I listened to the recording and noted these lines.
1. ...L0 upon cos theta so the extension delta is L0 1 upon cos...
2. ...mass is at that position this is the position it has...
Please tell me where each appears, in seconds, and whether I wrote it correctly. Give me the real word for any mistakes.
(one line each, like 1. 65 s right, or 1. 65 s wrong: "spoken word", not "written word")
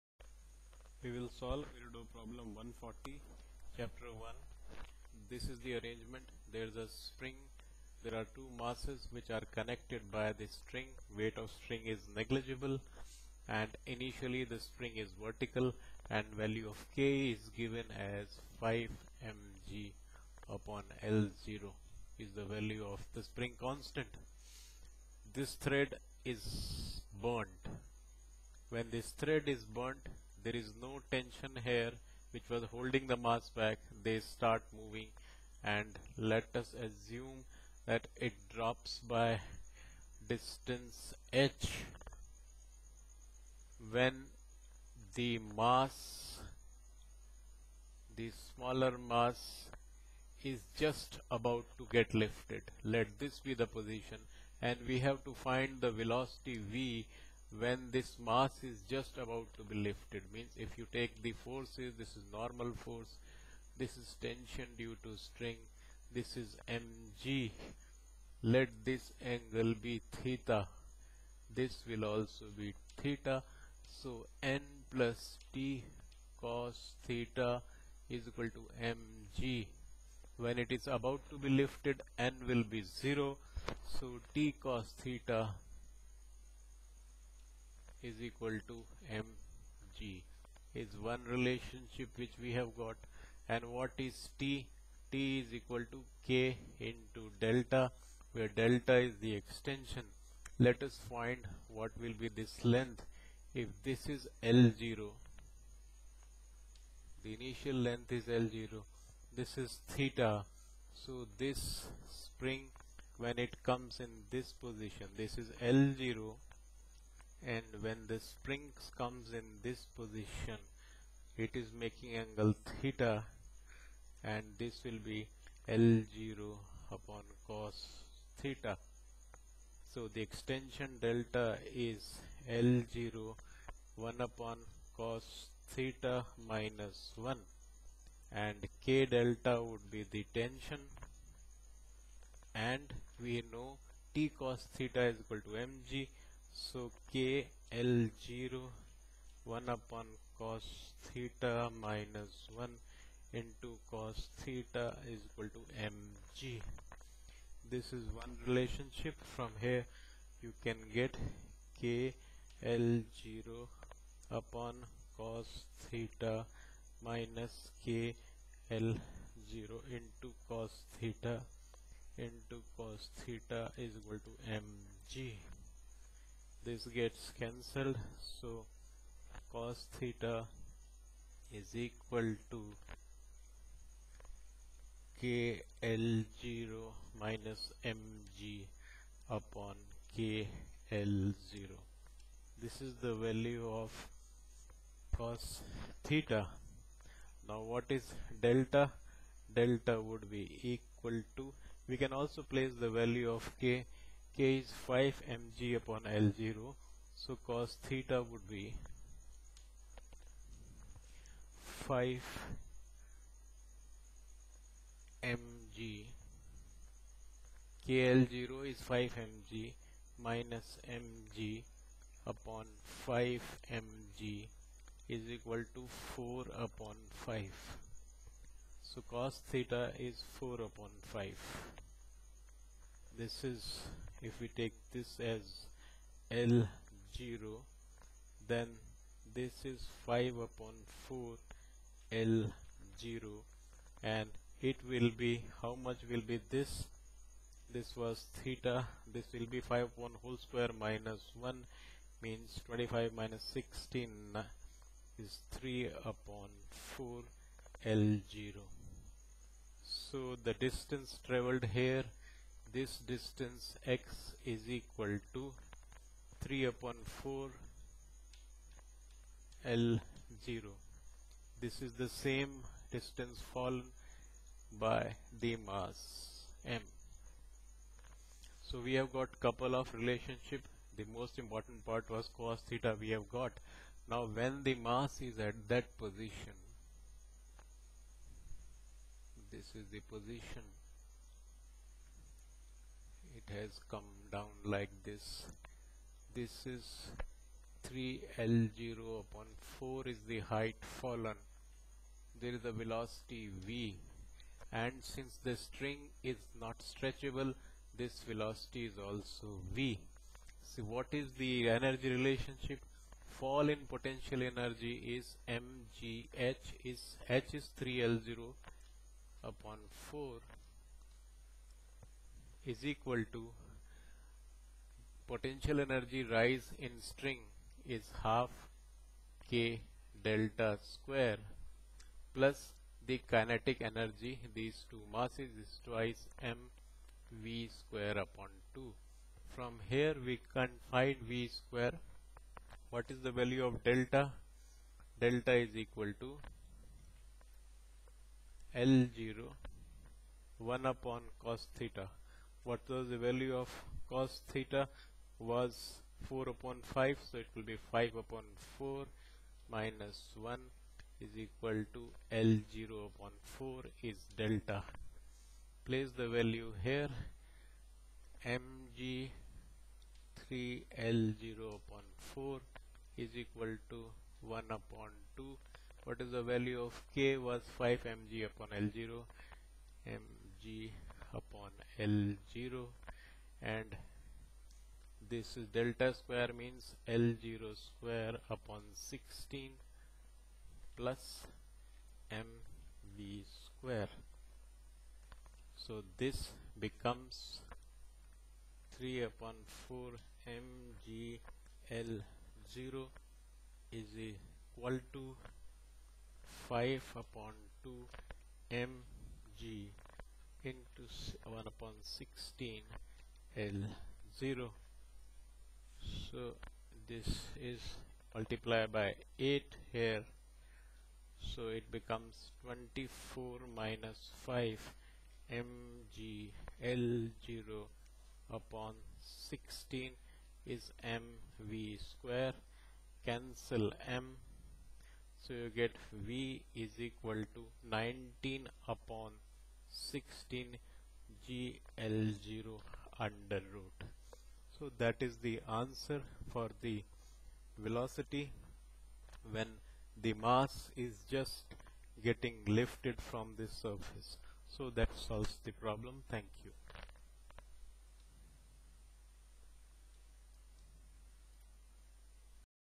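1. 125 s right
2. 284 s right.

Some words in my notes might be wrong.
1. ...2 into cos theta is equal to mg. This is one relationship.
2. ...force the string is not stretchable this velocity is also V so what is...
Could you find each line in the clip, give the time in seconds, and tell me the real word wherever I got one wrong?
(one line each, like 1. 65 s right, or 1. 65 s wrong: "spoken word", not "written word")
1. 152 s wrong: "1", not "2"
2. 305 s wrong: "since", not "force".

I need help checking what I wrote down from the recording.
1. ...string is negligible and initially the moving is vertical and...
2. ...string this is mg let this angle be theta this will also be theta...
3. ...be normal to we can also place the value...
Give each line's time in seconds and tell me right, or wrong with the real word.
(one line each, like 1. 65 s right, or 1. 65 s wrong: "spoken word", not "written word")
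1. 11 s wrong: "string", not "moving"
2. 65 s right
3. 200 s wrong: "equal", not "normal".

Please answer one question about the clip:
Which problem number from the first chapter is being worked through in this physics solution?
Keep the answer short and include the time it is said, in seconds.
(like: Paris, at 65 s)
140, at 2 s.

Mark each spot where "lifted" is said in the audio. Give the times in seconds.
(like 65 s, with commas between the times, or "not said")
52 s, 59 s, 81 s, 452 s.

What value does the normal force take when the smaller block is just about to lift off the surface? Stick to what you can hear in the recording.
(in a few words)
0.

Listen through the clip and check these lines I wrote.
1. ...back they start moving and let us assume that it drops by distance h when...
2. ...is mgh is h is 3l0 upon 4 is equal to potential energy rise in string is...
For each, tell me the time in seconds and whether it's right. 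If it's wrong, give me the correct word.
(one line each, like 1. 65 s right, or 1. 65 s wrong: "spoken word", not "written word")
1. 33 s right
2. 315 s right.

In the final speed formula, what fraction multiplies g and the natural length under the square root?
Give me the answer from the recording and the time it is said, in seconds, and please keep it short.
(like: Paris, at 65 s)
19/16, at 437 s.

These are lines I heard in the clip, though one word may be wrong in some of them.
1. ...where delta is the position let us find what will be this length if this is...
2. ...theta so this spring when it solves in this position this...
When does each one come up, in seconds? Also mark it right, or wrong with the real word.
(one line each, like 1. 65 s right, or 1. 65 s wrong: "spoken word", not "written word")
1. 98 s wrong: "extension", not "position"
2. 109 s wrong: "comes", not "solves".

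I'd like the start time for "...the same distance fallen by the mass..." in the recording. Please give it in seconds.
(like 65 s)
272 s.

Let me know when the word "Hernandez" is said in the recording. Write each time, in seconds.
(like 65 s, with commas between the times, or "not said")
not said.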